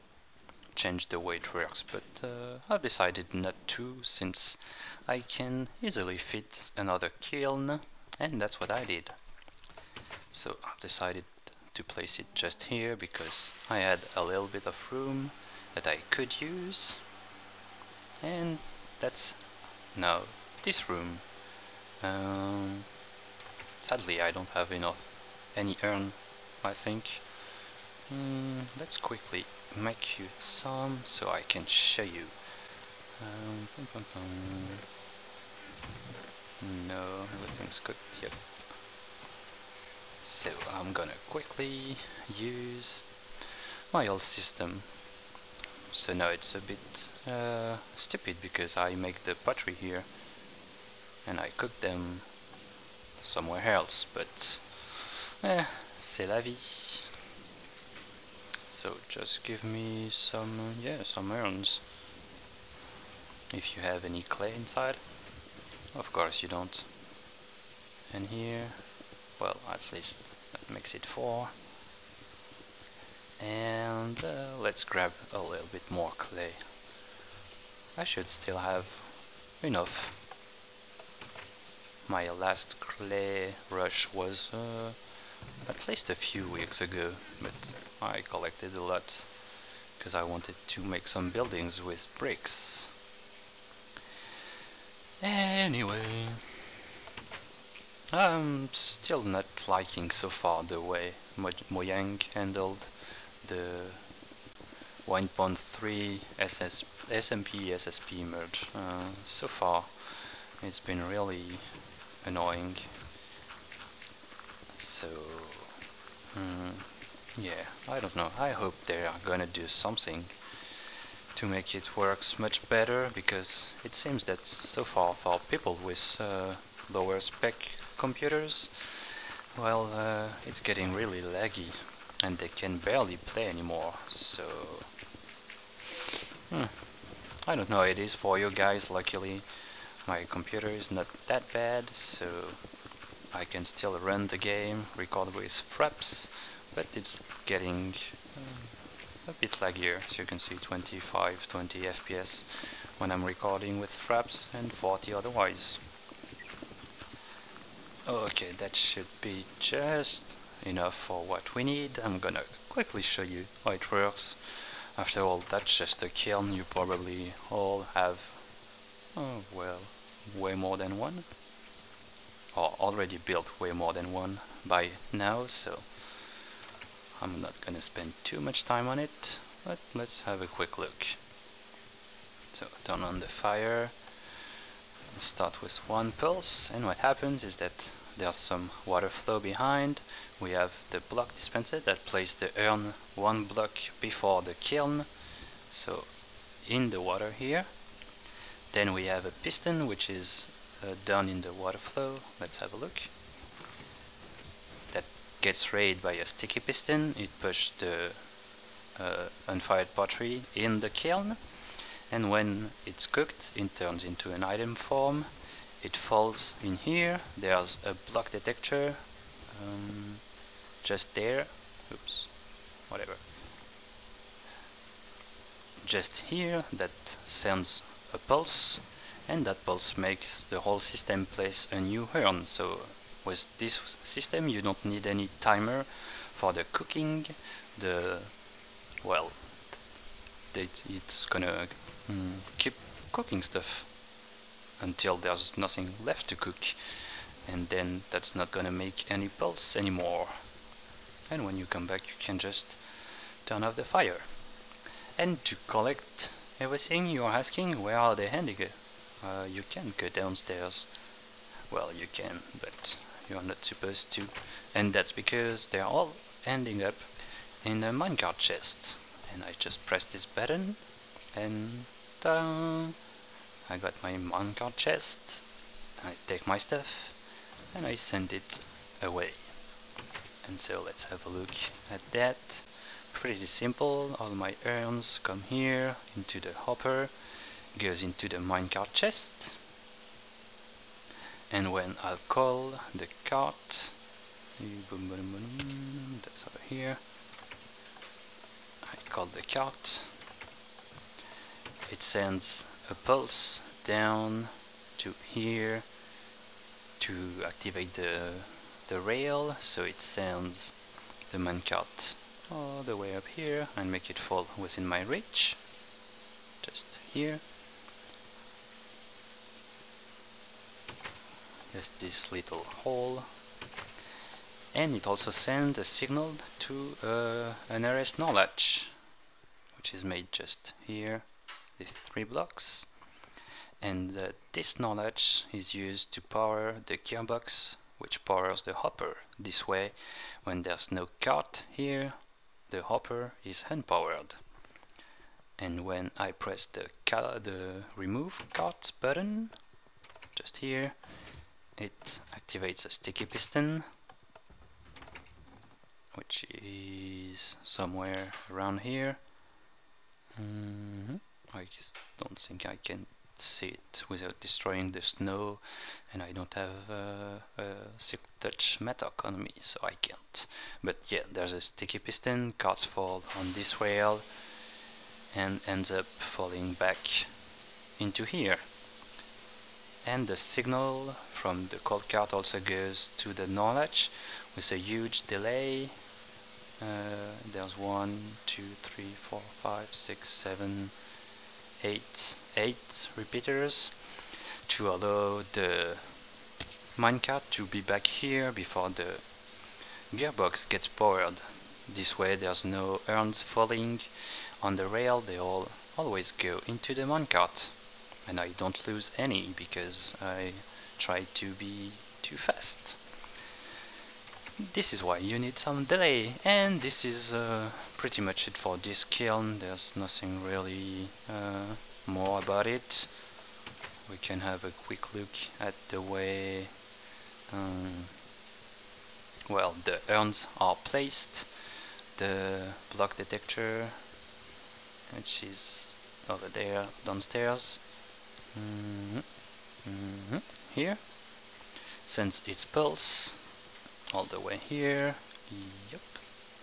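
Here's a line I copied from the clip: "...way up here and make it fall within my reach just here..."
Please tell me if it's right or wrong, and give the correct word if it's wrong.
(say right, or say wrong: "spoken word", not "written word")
right.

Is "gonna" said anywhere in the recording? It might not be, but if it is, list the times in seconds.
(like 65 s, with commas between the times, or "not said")
40 s, 119 s, 162 s, 177 s, 241 s, 248 s.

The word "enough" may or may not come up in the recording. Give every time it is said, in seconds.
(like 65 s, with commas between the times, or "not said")
24 s, 79 s, 160 s.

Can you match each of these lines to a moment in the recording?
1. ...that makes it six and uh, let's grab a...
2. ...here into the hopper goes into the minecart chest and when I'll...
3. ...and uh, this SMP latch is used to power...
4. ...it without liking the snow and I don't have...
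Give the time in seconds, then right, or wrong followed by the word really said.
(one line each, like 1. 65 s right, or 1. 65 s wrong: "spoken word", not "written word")
1. 70 s wrong: "four", not "six"
2. 285 s right
3. 333 s wrong: "NOR", not "SMP"
4. 363 s wrong: "destroying", not "liking".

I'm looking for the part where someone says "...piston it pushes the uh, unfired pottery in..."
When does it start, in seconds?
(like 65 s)
206 s.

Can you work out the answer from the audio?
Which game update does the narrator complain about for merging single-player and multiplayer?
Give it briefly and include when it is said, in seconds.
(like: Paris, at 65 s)
1.3, at 105 s.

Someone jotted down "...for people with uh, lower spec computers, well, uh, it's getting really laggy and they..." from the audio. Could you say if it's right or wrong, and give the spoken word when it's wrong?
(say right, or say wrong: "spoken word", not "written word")
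right.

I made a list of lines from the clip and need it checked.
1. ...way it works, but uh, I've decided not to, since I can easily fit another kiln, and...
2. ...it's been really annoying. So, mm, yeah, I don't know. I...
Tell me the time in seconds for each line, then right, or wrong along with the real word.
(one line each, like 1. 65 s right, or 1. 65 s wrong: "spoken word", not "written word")
1. 1 s right
2. 110 s right.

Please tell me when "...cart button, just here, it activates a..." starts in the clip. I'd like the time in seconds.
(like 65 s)
348 s.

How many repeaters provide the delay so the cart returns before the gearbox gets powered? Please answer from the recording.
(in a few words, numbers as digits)
8.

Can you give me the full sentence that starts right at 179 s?
But let's have a quick look.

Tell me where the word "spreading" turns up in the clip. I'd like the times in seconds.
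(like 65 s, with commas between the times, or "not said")
not said.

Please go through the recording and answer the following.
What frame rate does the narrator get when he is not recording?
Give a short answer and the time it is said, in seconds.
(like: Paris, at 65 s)
40, at 154 s.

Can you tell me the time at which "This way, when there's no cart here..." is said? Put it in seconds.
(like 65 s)
339 s.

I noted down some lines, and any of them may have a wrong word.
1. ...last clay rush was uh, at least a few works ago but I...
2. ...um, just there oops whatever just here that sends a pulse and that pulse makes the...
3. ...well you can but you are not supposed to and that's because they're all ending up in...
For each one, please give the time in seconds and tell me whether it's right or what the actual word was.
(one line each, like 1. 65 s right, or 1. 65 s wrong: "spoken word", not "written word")
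1. 82 s wrong: "weeks", not "works"
2. 219 s right
3. 261 s right.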